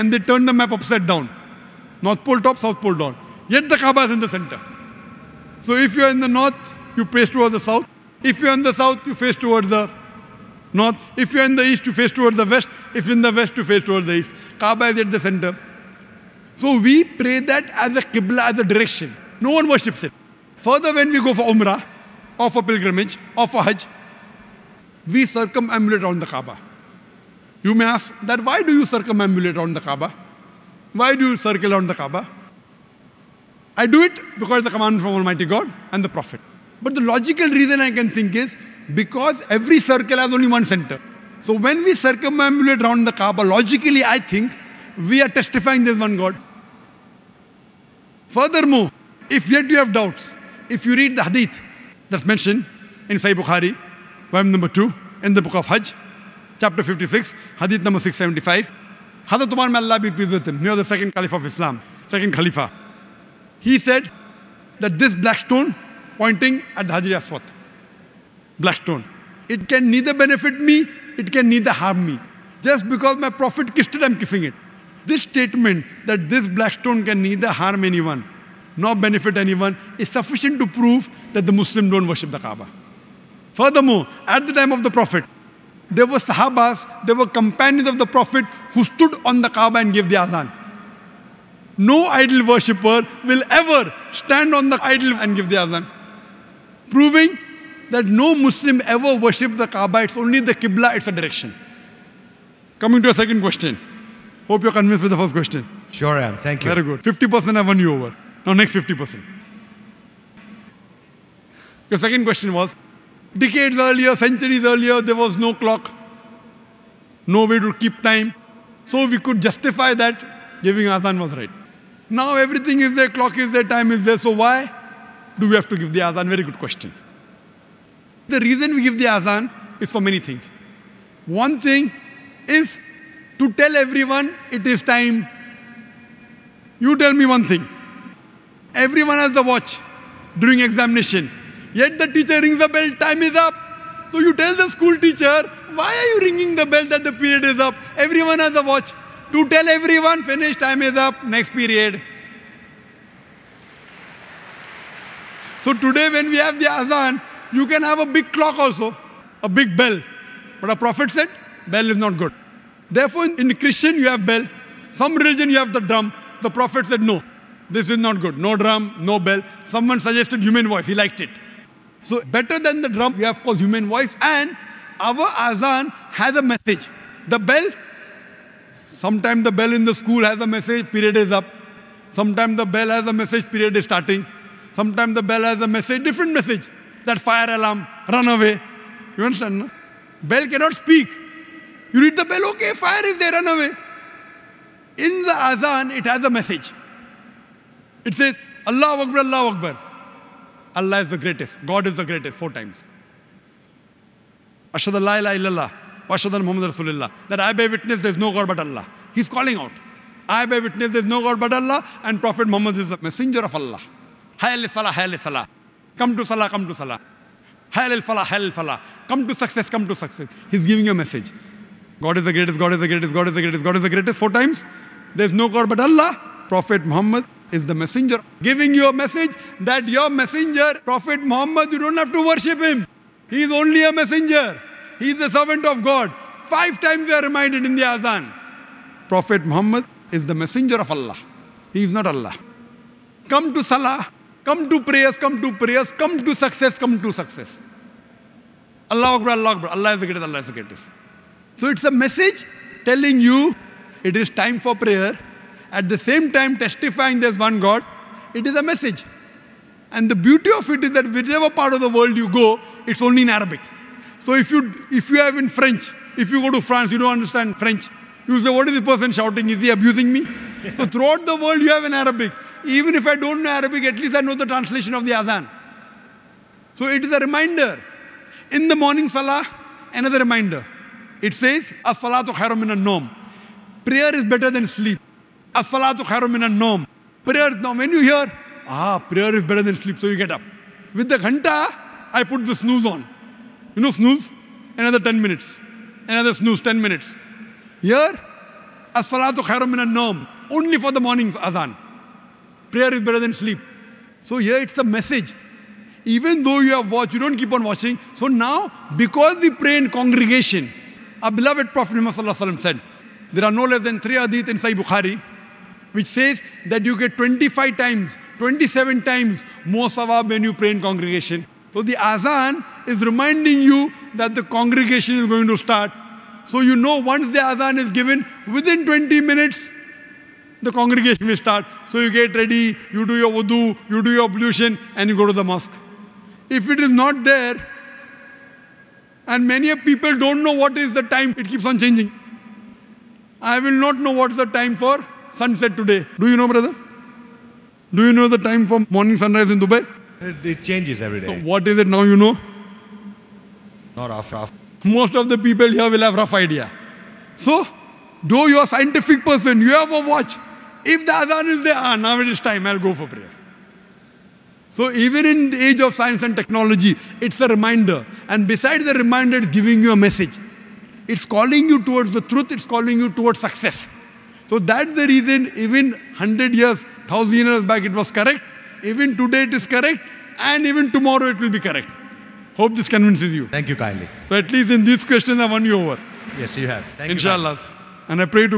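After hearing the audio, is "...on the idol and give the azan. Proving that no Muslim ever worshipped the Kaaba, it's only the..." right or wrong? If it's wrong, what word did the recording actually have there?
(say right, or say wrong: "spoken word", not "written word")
right.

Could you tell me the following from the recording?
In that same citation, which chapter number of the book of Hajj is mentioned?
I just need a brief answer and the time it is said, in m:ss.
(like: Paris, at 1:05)
56, at 0:56.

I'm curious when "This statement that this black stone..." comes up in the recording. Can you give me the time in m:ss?
1:15.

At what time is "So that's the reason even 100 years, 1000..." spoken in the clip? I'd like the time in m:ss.
6:14.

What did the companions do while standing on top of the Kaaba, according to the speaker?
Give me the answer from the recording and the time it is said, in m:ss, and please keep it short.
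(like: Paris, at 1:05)
Gave the azan, at 1:29.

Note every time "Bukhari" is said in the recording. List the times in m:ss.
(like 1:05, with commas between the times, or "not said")
0:53, 5:14.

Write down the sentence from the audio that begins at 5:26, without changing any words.
So you know once the azan is given, within 20 minutes, the congregation will start.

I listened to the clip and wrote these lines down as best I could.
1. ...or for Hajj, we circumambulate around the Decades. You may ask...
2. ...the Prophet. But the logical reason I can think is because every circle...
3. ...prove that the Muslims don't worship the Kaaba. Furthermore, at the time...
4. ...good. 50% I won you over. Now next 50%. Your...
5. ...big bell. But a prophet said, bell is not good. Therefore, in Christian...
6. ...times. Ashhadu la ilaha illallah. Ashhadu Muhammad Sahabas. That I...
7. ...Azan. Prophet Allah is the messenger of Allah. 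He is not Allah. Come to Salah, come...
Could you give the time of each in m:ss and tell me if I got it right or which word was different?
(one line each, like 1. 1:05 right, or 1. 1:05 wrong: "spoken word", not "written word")
1. 0:23 wrong: "Kaaba", not "Decades"
2. 0:36 right
3. 1:20 right
4. 1:46 right
5. 2:39 right
6. 3:22 wrong: "Rasulullah", not "Sahabas"
7. 3:57 wrong: "Muhammad", not "Allah".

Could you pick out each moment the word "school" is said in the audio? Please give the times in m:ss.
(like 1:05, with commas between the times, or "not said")
2:24, 2:59.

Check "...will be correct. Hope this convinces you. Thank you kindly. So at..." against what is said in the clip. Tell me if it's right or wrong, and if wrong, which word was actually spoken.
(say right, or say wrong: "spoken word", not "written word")
right.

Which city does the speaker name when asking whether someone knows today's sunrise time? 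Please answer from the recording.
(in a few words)
Dubai.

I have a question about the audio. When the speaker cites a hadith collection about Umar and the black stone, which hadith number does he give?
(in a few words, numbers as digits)
675.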